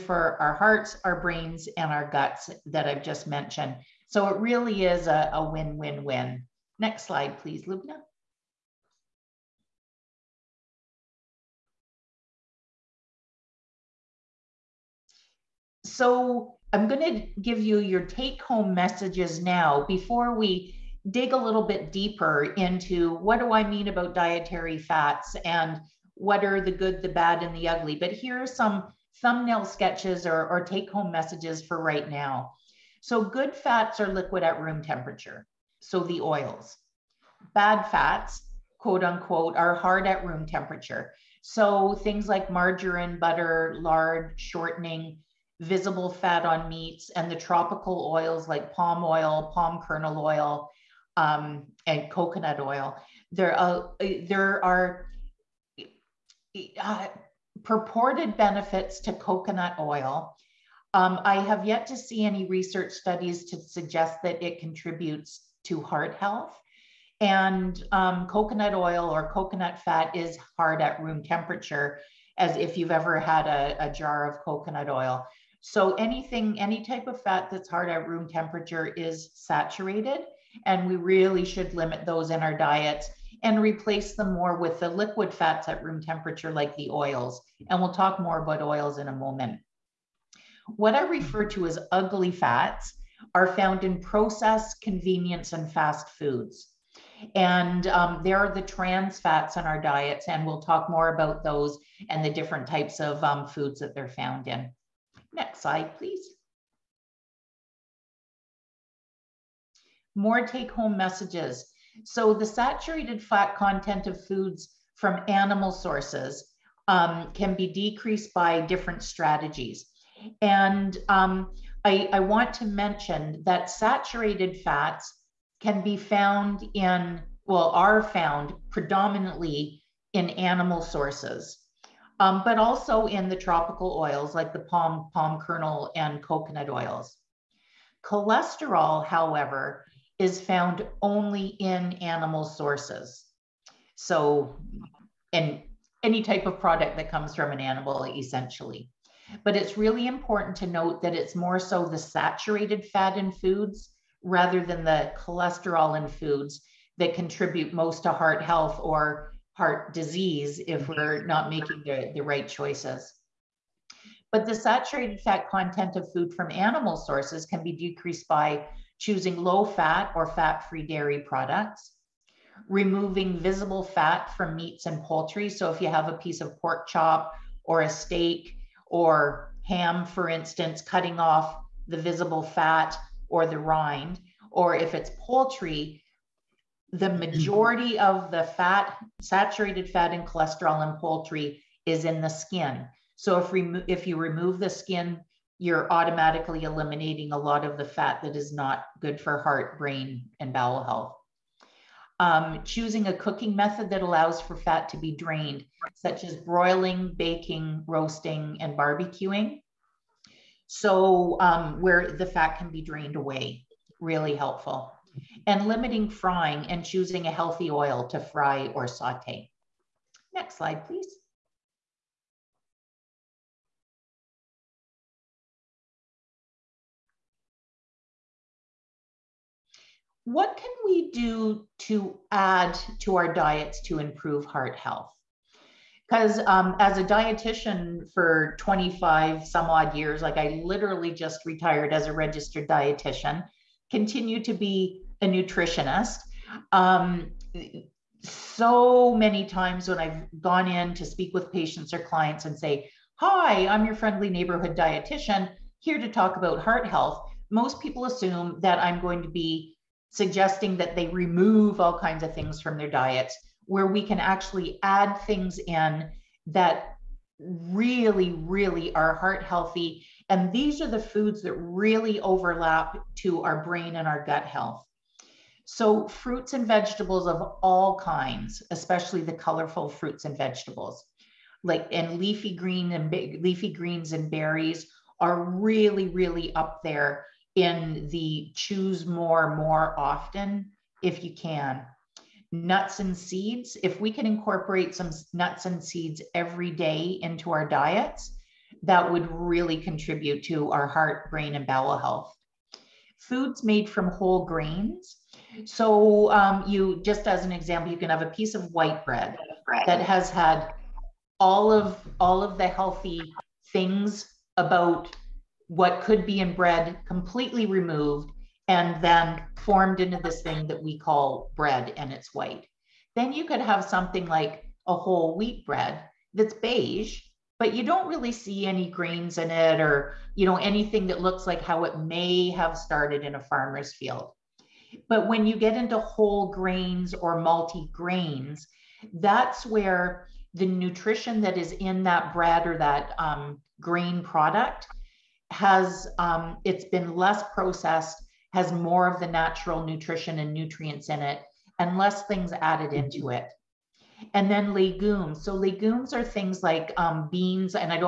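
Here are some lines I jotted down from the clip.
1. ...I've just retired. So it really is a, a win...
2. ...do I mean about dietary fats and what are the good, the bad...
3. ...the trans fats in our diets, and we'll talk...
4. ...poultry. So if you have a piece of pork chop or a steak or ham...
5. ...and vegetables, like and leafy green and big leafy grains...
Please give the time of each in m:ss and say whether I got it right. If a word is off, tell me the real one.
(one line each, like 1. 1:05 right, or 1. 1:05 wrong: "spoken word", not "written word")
1. 0:02 wrong: "mentioned", not "retired"
2. 0:23 right
3. 1:38 right
4. 2:55 right
5. 4:40 wrong: "greens", not "grains".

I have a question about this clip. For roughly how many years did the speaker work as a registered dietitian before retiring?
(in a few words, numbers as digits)
25.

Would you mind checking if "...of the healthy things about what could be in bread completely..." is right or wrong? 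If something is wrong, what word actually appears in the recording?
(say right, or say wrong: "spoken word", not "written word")
right.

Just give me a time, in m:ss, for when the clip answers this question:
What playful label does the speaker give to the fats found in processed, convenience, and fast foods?
1:31.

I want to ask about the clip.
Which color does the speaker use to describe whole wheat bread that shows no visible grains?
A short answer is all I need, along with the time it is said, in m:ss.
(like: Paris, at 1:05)
Beige, at 5:26.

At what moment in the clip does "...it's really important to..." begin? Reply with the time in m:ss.
2:29.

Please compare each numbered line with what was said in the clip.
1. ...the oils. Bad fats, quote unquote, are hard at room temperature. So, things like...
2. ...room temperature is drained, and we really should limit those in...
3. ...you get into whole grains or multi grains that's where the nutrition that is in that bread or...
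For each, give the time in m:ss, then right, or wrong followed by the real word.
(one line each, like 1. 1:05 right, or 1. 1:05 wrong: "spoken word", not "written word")
1. 0:35 right
2. 1:18 wrong: "saturated", not "drained"
3. 5:35 right.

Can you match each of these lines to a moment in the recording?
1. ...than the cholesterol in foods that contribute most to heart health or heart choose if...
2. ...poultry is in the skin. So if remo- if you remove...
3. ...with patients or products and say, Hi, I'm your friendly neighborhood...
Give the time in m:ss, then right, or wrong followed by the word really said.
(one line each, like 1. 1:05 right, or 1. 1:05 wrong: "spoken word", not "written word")
1. 2:34 wrong: "disease", not "choose"
2. 3:11 right
3. 4:11 wrong: "clients", not "products".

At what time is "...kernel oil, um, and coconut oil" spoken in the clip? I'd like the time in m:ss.
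0:49.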